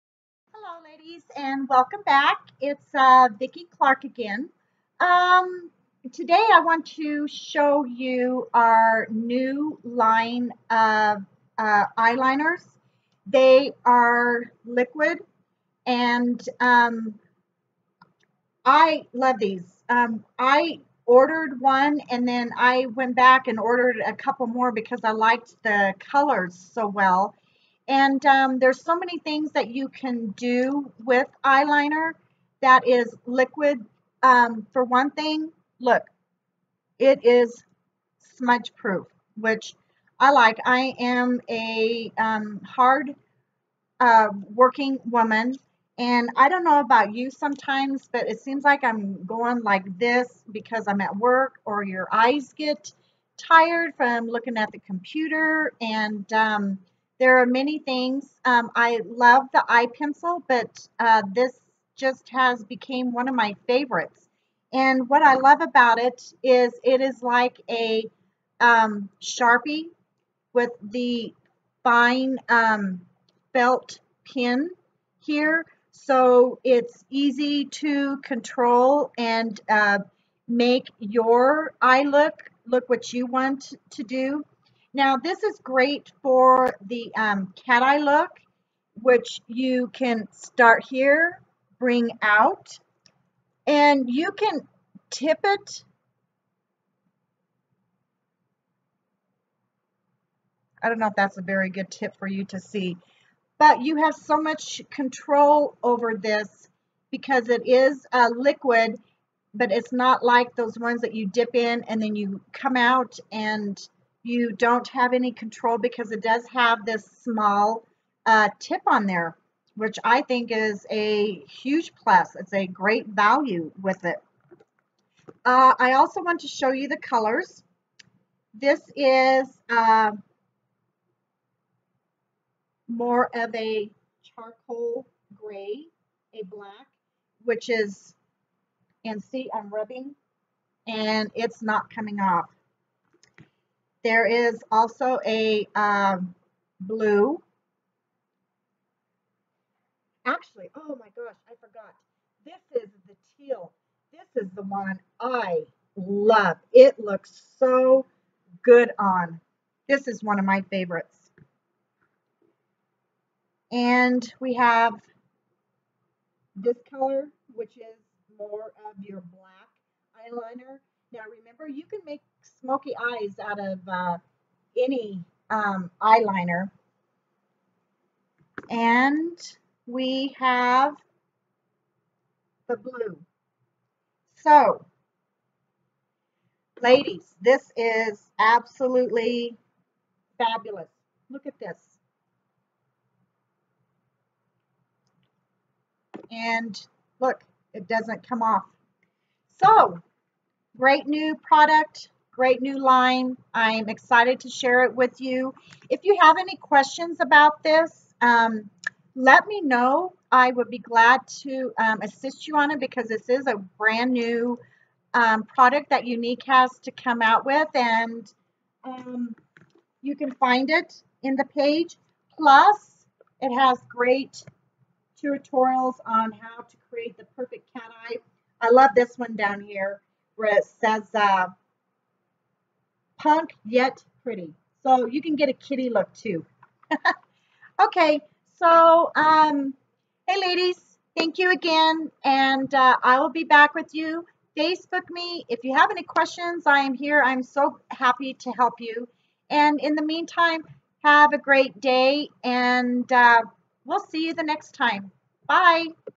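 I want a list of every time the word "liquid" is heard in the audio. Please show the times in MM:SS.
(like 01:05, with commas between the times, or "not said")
00:14, 00:33, 01:48.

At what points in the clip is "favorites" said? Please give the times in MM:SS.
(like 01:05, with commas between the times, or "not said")
01:03, 02:40.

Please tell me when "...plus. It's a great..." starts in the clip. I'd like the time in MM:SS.
02:02.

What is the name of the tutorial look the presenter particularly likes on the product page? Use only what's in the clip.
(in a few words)
Punk yet pretty.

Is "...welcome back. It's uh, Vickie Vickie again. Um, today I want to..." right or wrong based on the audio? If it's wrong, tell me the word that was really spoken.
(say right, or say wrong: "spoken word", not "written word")
wrong: "Clark", not "Vickie".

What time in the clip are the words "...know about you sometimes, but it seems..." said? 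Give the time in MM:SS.
00:46.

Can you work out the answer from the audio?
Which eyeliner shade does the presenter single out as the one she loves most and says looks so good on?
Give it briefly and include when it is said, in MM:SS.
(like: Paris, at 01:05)
Teal, at 02:33.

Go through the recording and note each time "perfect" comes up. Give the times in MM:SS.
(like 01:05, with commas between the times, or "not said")
03:47.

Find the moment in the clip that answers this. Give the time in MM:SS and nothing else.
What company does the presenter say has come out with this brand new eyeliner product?
03:36.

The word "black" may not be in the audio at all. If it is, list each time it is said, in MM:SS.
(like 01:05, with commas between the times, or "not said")
02:16, 02:49.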